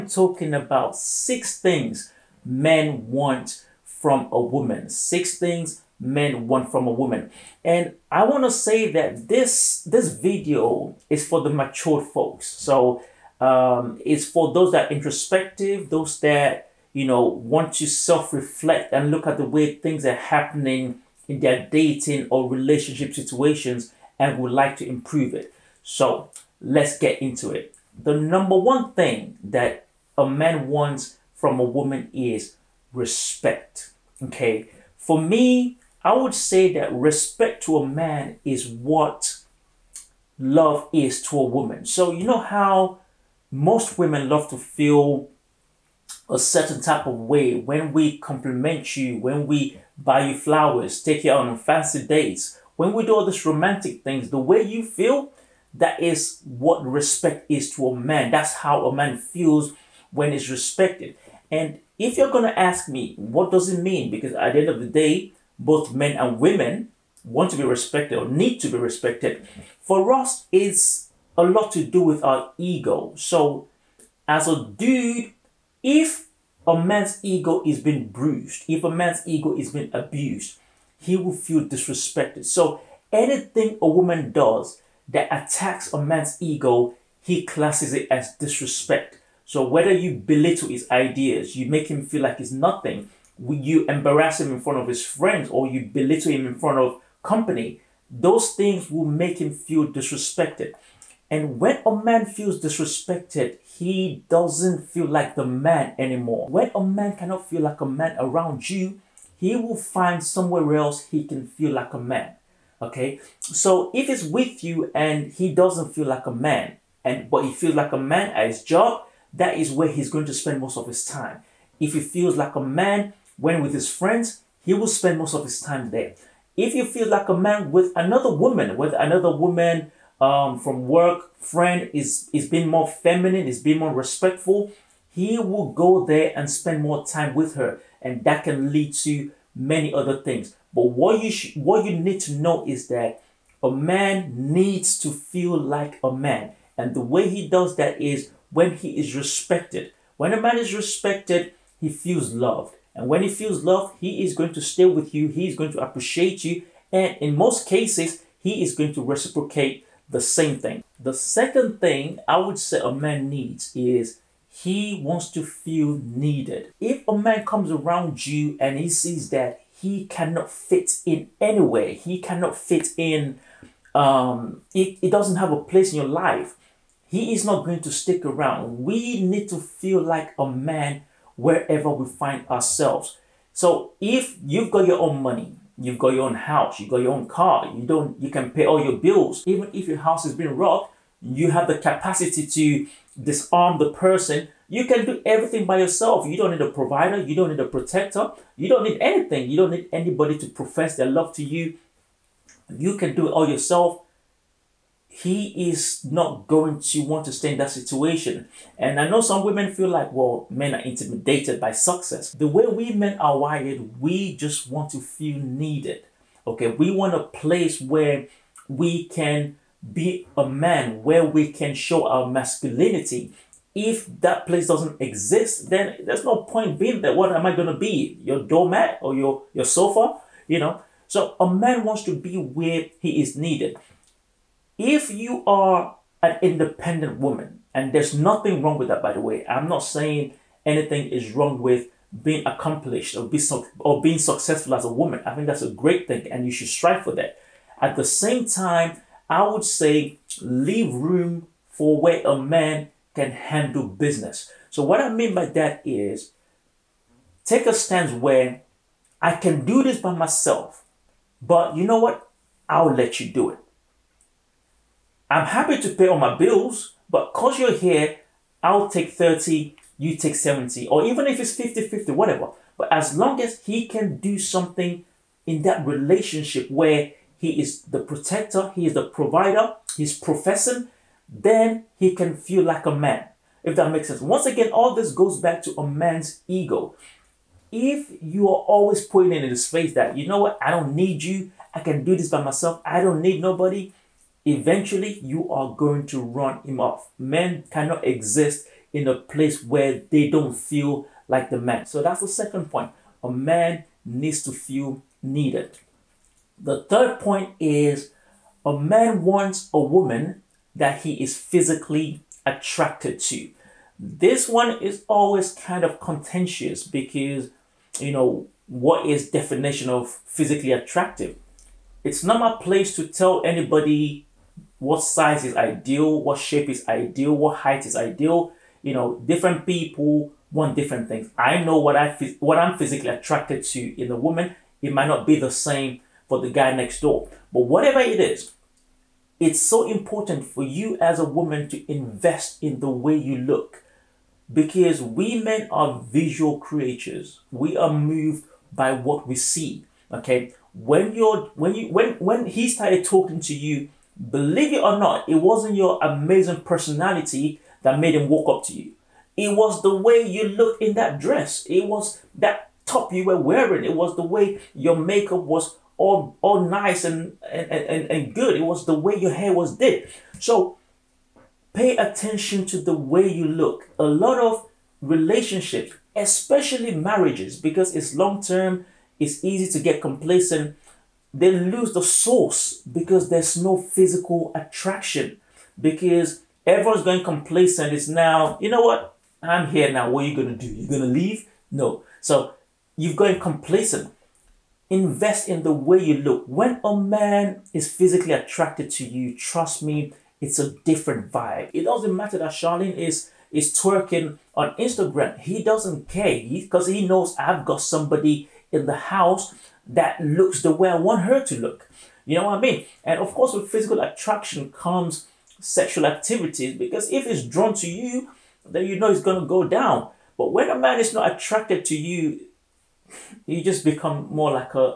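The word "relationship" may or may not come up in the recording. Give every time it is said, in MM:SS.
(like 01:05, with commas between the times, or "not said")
00:22, 04:35, 06:15.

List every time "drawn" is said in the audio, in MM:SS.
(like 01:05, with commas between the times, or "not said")
06:57.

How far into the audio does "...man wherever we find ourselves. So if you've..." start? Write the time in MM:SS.
03:00.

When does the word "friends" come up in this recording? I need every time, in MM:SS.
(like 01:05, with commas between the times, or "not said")
01:35, 02:03, 02:11.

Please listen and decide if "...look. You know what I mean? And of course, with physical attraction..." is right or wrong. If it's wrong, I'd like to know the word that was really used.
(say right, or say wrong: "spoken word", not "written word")
right.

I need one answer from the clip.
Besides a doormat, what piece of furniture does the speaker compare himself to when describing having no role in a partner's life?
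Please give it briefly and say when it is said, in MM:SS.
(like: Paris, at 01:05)
sofa, at 03:49.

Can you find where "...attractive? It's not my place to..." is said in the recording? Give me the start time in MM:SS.
05:20.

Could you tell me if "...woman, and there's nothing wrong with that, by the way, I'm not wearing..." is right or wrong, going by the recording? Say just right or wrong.
wrong.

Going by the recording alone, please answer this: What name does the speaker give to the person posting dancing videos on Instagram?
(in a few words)
Charlene.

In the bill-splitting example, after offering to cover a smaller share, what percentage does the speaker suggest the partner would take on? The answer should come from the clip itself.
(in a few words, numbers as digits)
70.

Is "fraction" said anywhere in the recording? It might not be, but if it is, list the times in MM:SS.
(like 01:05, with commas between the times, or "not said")
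not said.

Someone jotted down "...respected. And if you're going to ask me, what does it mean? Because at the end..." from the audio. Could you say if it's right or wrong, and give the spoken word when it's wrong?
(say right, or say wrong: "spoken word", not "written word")
right.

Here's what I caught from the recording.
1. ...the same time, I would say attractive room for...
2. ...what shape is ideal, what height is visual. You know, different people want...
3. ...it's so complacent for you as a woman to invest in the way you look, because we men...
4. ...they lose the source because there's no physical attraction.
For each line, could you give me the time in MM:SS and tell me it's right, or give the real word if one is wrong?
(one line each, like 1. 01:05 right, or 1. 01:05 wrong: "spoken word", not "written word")
1. 04:07 wrong: "leave", not "attractive"
2. 05:26 wrong: "ideal", not "visual"
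3. 05:39 wrong: "important", not "complacent"
4. 06:21 right.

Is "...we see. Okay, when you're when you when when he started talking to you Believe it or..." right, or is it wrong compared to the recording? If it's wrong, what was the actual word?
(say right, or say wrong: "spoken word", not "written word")
right.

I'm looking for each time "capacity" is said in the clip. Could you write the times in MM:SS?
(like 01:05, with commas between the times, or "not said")
03:11.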